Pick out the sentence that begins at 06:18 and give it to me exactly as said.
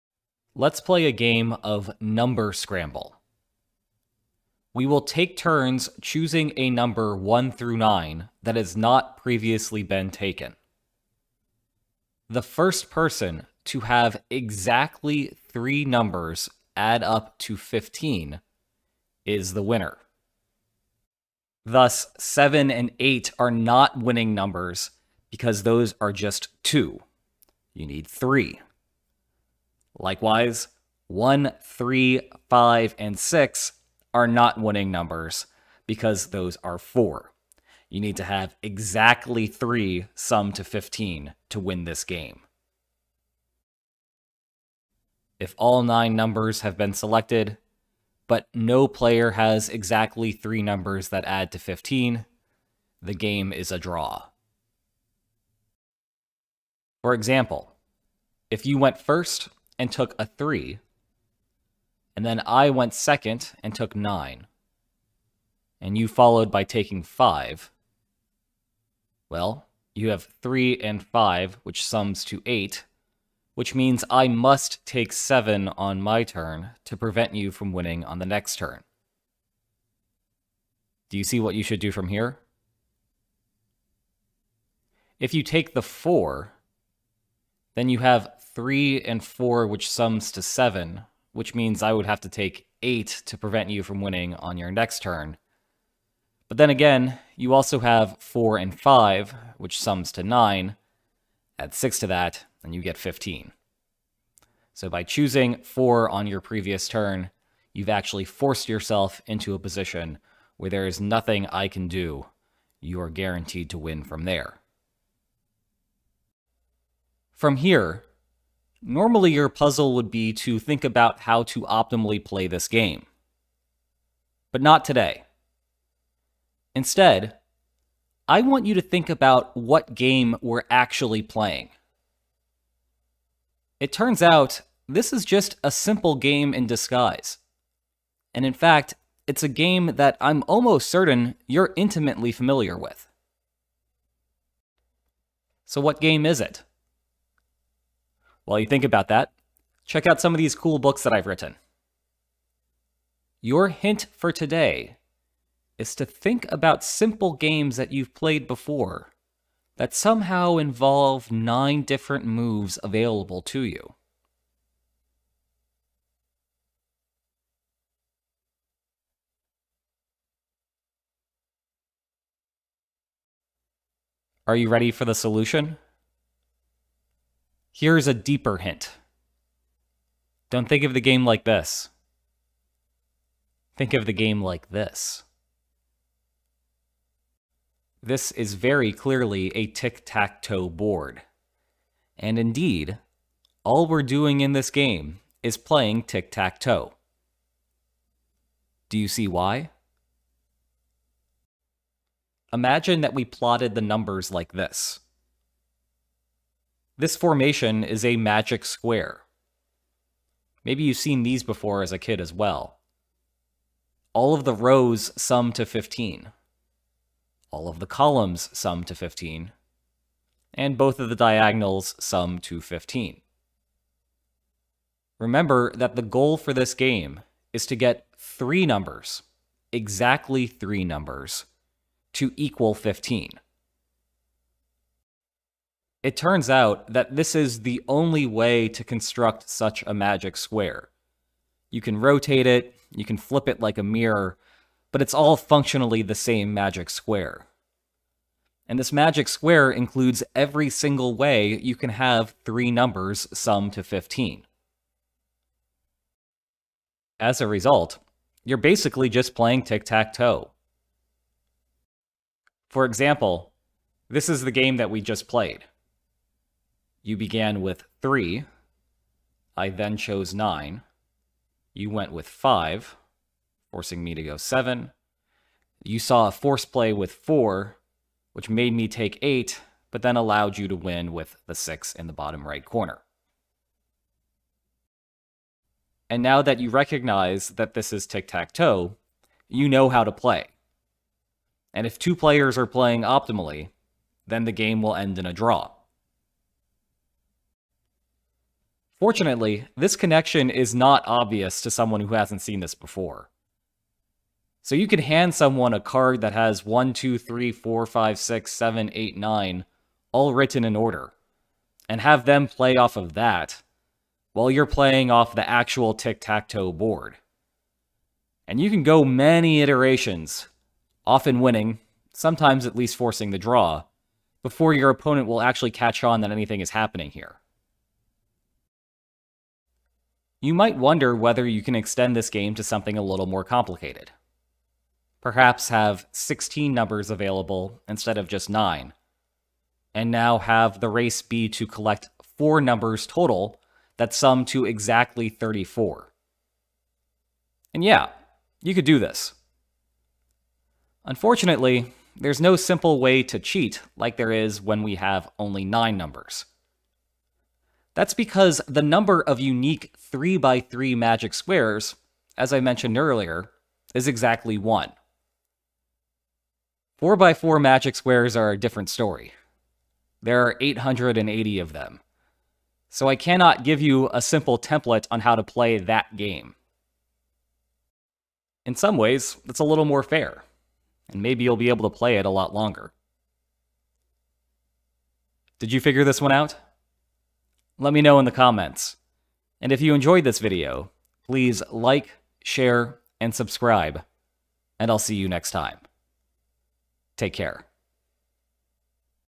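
In some ways, it's a little more fair, and maybe you'll be able to play it a lot longer.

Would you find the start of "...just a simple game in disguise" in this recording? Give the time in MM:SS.
02:15.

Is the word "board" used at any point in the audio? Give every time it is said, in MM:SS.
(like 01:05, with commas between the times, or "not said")
03:10, 05:16.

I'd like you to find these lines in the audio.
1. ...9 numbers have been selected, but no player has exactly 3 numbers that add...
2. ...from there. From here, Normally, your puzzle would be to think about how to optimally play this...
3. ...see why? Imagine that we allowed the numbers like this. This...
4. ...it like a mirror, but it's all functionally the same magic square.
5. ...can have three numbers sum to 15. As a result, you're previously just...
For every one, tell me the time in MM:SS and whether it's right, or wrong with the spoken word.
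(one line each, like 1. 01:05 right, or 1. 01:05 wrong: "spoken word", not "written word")
1. 00:45 right
2. 01:54 right
3. 03:19 wrong: "plotted", not "allowed"
4. 04:03 right
5. 04:11 wrong: "basically", not "previously".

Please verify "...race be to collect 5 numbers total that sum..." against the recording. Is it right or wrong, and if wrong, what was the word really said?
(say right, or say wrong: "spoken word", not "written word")
wrong: "4", not "5".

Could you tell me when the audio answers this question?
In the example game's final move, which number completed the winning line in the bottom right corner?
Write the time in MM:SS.
04:41.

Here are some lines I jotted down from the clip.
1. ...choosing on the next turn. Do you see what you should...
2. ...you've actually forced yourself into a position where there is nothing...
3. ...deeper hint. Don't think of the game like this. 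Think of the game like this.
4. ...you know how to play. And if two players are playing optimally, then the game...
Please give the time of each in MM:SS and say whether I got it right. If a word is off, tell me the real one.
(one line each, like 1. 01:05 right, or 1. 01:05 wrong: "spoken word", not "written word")
1. 01:17 wrong: "winning", not "choosing"
2. 01:47 right
3. 02:58 right
4. 04:49 right.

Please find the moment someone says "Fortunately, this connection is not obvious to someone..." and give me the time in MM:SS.
04:59.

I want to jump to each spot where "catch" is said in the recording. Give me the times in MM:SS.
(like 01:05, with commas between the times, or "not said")
05:25.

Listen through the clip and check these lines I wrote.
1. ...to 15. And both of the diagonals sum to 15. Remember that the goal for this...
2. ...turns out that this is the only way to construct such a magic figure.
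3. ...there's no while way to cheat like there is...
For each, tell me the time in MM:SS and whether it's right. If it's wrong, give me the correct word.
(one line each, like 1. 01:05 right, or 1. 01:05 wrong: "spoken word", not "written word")
1. 03:38 right
2. 03:56 wrong: "square", not "figure"
3. 05:52 wrong: "simple", not "while".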